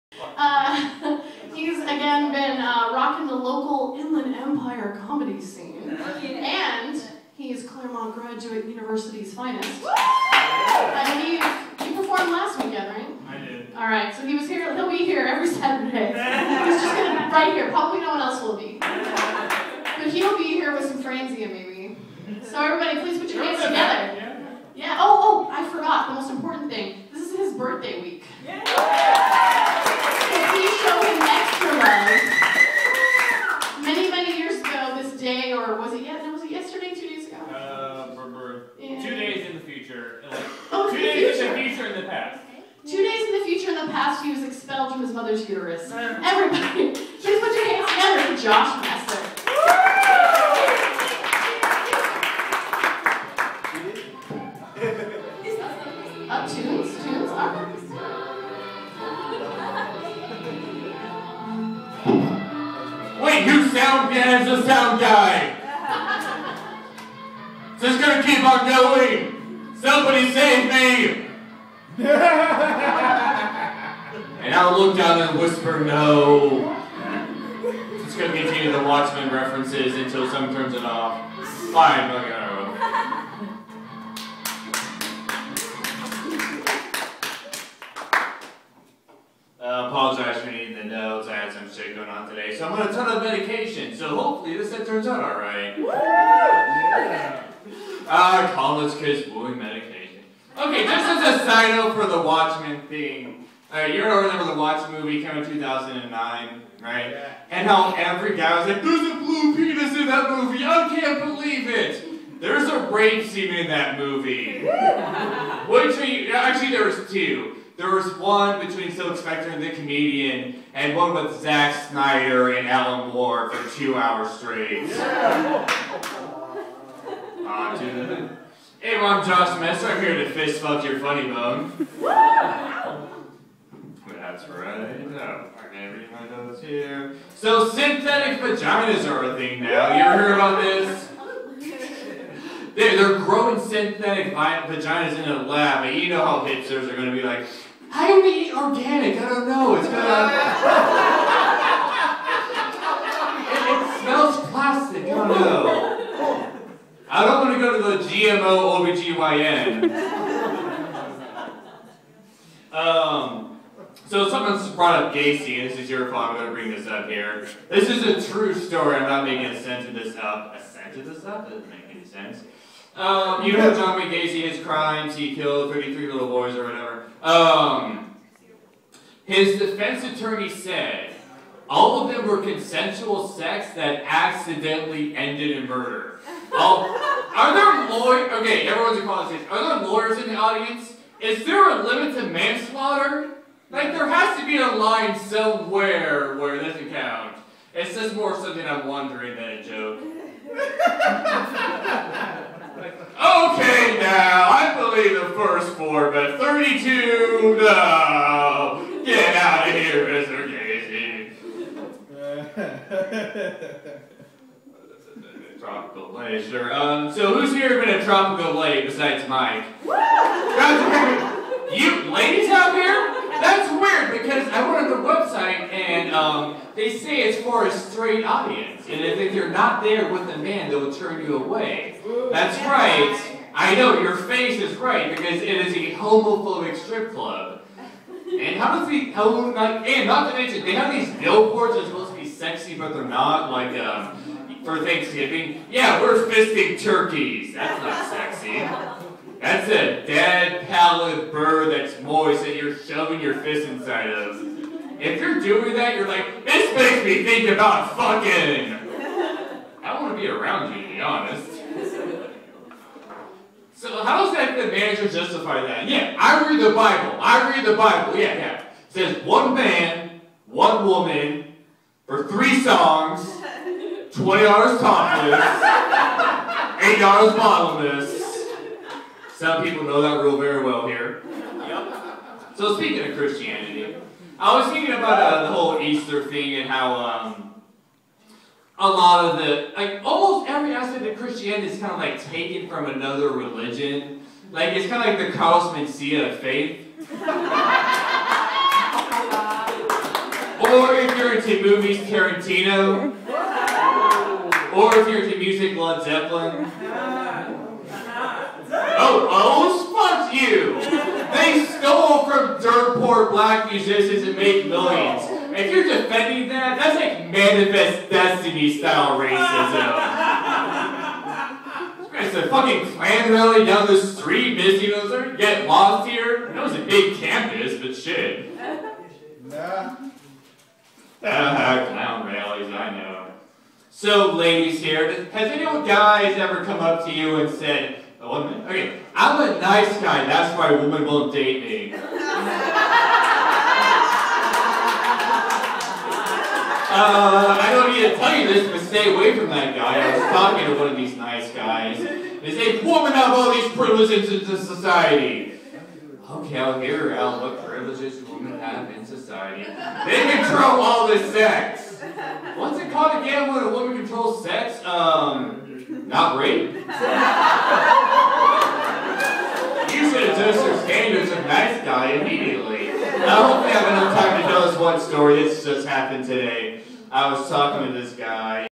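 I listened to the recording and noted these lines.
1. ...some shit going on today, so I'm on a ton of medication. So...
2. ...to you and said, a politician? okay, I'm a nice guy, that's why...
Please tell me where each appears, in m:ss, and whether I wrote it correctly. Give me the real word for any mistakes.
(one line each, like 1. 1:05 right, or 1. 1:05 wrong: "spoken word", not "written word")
1. 1:31 right
2. 5:37 wrong: "woman", not "politician".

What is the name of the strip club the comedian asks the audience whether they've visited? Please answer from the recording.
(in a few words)
Tropical Lei.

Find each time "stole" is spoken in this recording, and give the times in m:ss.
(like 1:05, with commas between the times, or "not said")
5:11.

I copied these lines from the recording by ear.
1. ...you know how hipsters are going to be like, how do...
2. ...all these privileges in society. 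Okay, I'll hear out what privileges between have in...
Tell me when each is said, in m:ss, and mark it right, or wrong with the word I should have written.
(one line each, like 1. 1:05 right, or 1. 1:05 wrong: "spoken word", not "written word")
1. 2:26 right
2. 5:53 wrong: "women", not "between".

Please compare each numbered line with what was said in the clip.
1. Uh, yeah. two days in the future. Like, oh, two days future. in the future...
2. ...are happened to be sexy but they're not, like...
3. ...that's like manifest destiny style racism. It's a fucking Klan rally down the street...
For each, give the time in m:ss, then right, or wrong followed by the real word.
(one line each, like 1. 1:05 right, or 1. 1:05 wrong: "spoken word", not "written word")
1. 0:37 right
2. 4:01 wrong: "supposed", not "happened"
3. 5:16 right.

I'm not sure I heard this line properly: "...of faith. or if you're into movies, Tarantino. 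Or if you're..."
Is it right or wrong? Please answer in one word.
right.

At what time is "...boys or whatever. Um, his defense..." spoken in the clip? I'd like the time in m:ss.
2:56.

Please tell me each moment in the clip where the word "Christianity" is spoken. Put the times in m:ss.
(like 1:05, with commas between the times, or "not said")
4:43, 4:51.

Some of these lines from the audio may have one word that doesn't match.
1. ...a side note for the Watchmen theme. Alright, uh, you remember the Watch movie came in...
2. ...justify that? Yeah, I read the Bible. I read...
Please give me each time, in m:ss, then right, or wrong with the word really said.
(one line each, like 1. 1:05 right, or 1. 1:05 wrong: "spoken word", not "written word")
1. 1:41 right
2. 4:25 right.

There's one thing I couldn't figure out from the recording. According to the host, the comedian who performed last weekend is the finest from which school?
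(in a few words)
Claremont Graduate University.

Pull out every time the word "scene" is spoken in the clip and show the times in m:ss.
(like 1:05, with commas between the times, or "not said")
0:05, 1:53.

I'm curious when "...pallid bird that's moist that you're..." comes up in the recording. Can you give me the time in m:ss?
4:10.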